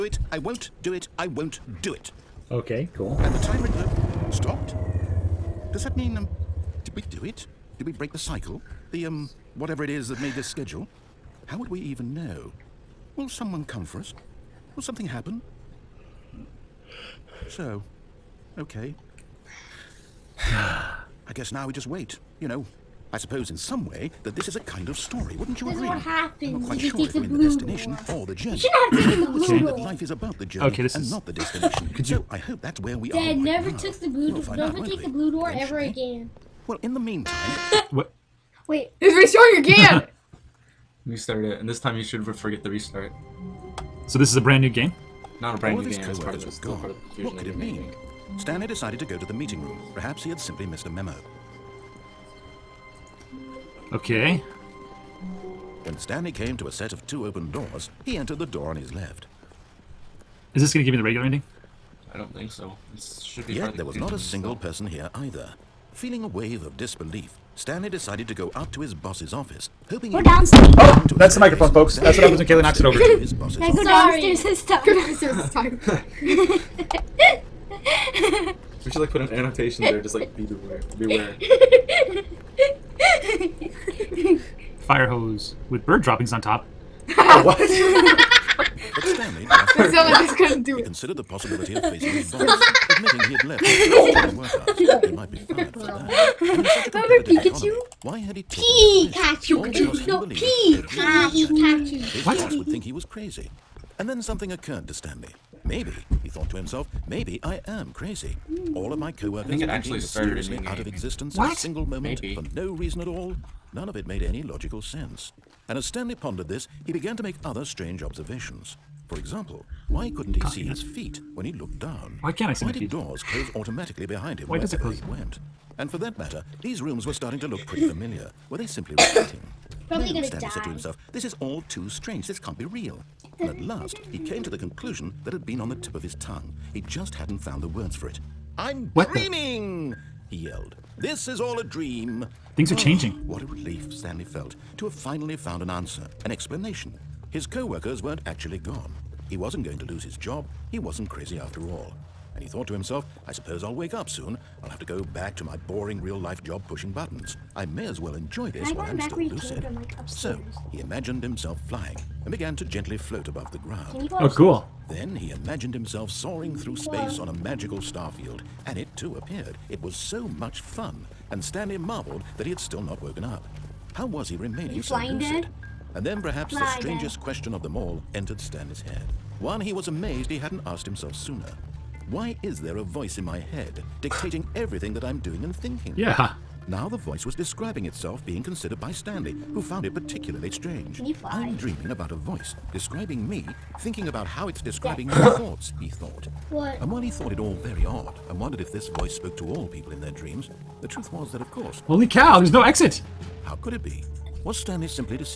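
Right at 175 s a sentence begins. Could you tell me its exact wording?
And then perhaps the strangest question of them all entered Stanley's head.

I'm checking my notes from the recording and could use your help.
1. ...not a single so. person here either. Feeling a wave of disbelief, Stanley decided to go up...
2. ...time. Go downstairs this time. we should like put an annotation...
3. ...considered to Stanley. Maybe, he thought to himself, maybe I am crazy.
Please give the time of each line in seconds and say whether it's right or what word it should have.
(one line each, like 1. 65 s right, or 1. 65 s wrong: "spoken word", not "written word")
1. 63 s right
2. 74 s right
3. 104 s wrong: "occurred", not "considered".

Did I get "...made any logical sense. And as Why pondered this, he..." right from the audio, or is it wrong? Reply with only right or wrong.
wrong.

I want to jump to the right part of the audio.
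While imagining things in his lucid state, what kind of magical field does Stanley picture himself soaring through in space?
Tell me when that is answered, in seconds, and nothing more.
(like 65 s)
167 s.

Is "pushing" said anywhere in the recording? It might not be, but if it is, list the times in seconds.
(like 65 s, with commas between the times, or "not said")
156 s.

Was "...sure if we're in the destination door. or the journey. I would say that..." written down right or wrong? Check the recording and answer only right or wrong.
right.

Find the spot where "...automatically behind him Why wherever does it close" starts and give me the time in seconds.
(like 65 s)
123 s.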